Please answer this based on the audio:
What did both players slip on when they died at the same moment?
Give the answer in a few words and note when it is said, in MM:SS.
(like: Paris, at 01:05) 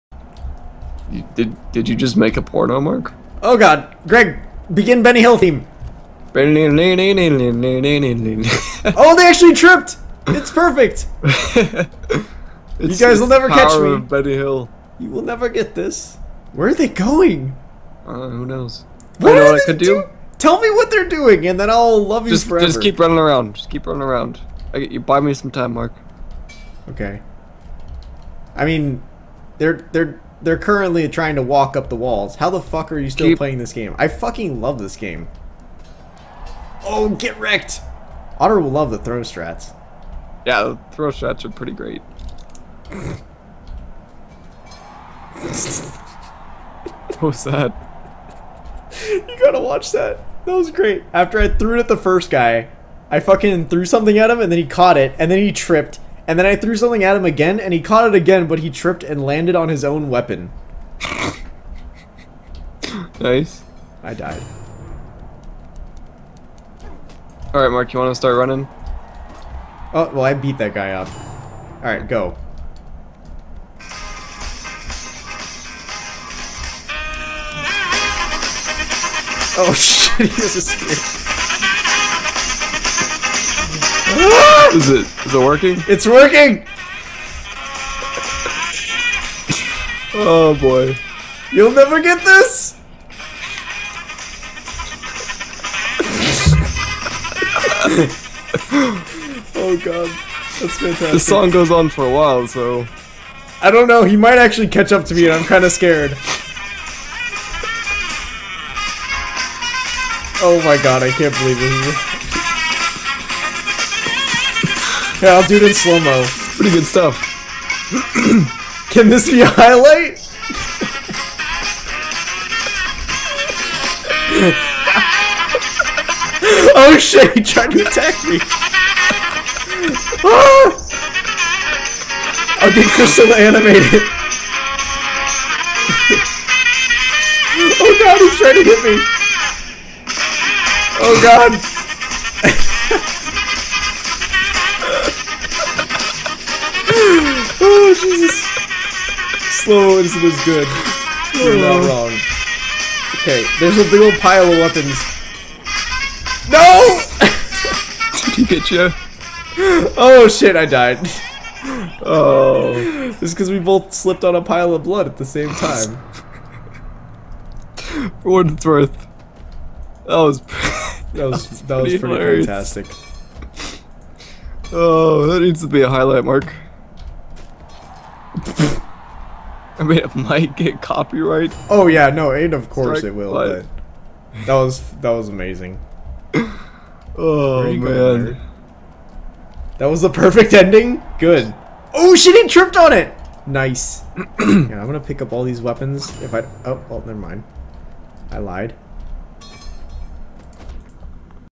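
a pile of blood, at 02:44.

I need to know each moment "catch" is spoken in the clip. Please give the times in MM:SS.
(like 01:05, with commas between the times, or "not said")
00:13, 01:44.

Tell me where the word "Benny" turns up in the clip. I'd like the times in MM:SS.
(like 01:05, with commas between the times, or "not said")
00:05, 00:13.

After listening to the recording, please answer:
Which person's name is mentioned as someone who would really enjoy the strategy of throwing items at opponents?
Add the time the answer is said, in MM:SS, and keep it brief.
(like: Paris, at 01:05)
Otter, at 00:38.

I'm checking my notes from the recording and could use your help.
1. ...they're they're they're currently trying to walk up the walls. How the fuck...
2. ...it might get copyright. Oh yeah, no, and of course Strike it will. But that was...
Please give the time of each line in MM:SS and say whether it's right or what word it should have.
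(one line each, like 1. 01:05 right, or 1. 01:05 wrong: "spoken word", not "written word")
1. 00:29 right
2. 02:59 right.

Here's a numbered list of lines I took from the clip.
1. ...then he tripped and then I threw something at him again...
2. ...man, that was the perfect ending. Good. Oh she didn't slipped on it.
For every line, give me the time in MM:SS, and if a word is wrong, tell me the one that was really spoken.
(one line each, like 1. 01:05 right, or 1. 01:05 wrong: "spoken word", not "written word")
1. 00:55 right
2. 03:07 wrong: "tripped", not "slipped".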